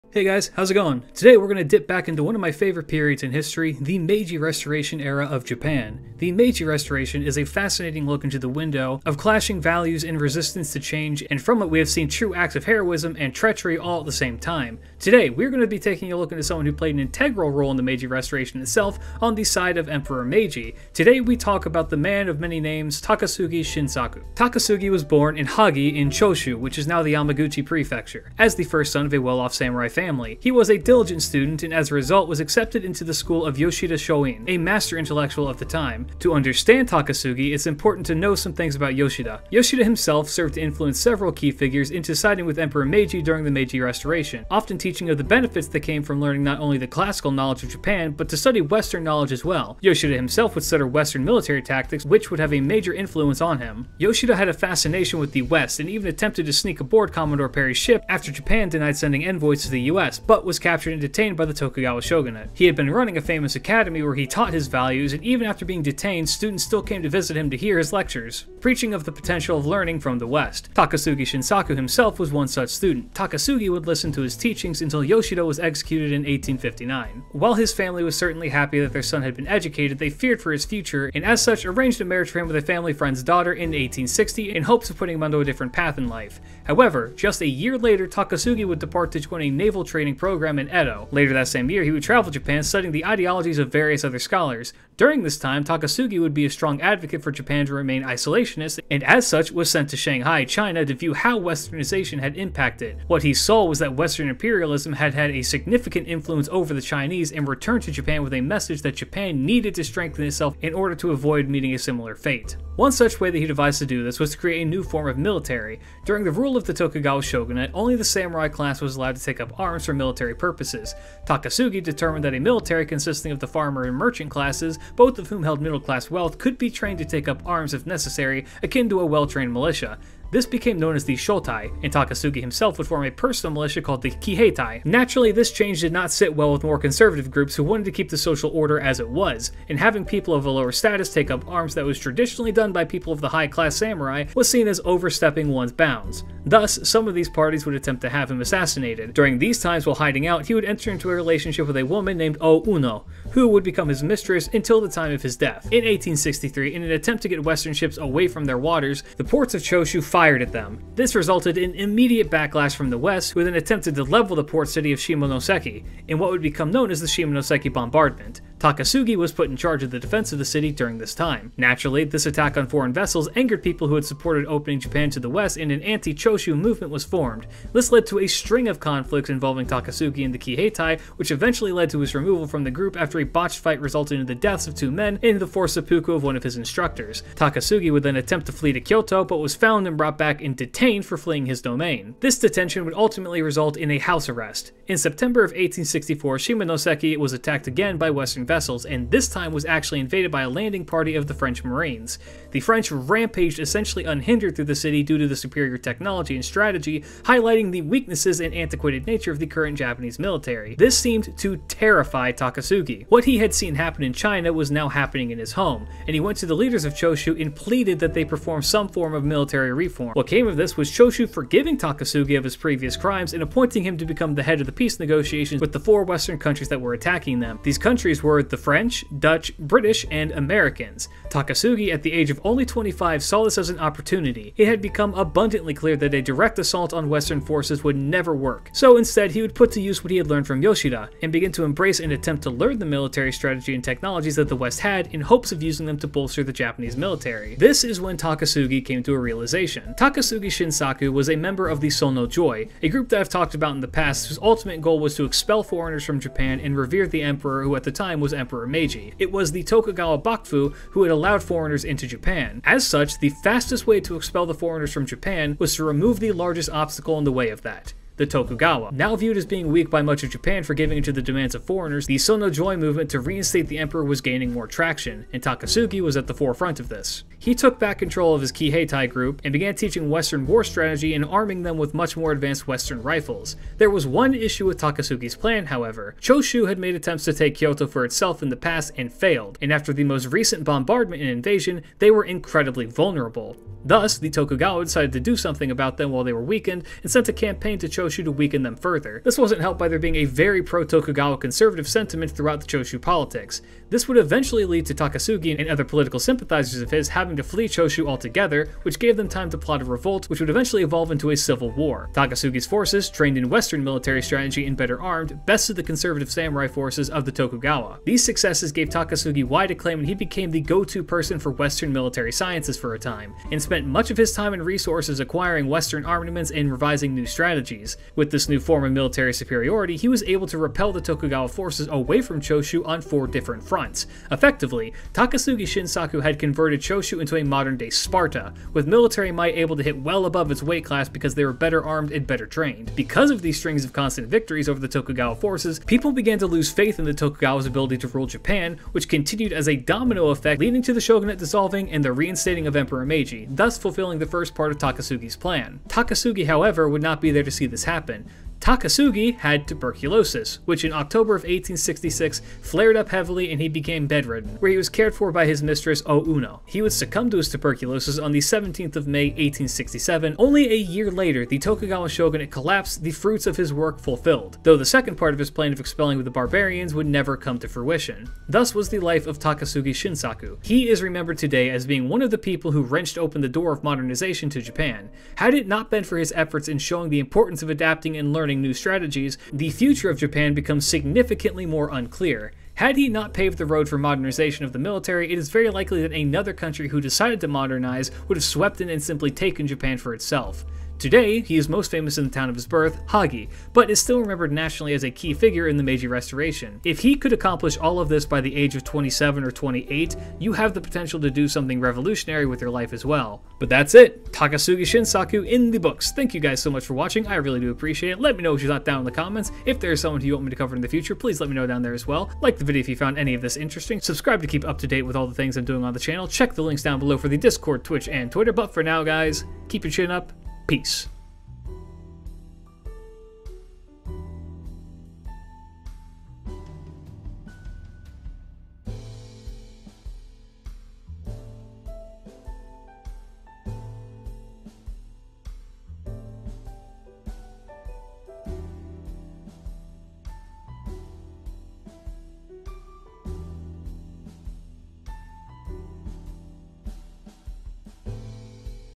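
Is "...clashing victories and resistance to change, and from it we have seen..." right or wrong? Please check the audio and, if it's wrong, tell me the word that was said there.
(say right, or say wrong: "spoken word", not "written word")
wrong: "values", not "victories".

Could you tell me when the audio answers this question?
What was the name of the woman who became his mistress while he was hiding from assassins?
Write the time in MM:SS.
02:32.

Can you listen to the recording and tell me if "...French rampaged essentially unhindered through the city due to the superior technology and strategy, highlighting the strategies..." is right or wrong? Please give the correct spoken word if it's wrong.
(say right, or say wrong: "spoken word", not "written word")
wrong: "weaknesses", not "strategies".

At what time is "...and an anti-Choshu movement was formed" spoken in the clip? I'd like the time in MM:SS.
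02:55.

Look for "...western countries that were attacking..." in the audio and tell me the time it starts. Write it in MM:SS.
03:46.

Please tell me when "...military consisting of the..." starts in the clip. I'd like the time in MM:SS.
02:02.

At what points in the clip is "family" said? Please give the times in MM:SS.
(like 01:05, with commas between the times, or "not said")
00:29, 01:17, 01:22.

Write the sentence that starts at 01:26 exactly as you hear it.
However, just a year later, Takasugi would depart to join a naval naval training program in Edo.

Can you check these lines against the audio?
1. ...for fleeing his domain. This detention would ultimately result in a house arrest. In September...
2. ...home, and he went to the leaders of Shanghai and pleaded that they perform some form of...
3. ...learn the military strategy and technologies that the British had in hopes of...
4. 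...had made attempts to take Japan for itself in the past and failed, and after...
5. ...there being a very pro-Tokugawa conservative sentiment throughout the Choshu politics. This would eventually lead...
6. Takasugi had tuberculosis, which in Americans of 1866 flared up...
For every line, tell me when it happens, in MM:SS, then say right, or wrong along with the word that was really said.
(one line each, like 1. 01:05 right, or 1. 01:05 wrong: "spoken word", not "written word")
1. 03:11 right
2. 03:35 wrong: "Choshu", not "Shanghai"
3. 04:02 wrong: "West", not "British"
4. 04:46 wrong: "Kyoto", not "Japan"
5. 04:59 right
6. 05:58 wrong: "October", not "Americans".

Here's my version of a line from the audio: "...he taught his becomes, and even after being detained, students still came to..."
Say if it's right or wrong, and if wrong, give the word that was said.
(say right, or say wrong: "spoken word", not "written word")
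wrong: "values", not "becomes".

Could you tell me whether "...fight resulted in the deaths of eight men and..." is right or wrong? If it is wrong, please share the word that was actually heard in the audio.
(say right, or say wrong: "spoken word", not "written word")
wrong: "two", not "eight".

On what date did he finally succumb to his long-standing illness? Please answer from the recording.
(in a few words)
17 May 1867.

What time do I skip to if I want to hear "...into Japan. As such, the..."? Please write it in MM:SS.
04:21.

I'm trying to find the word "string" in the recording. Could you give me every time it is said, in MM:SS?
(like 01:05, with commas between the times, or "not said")
02:58, 05:43.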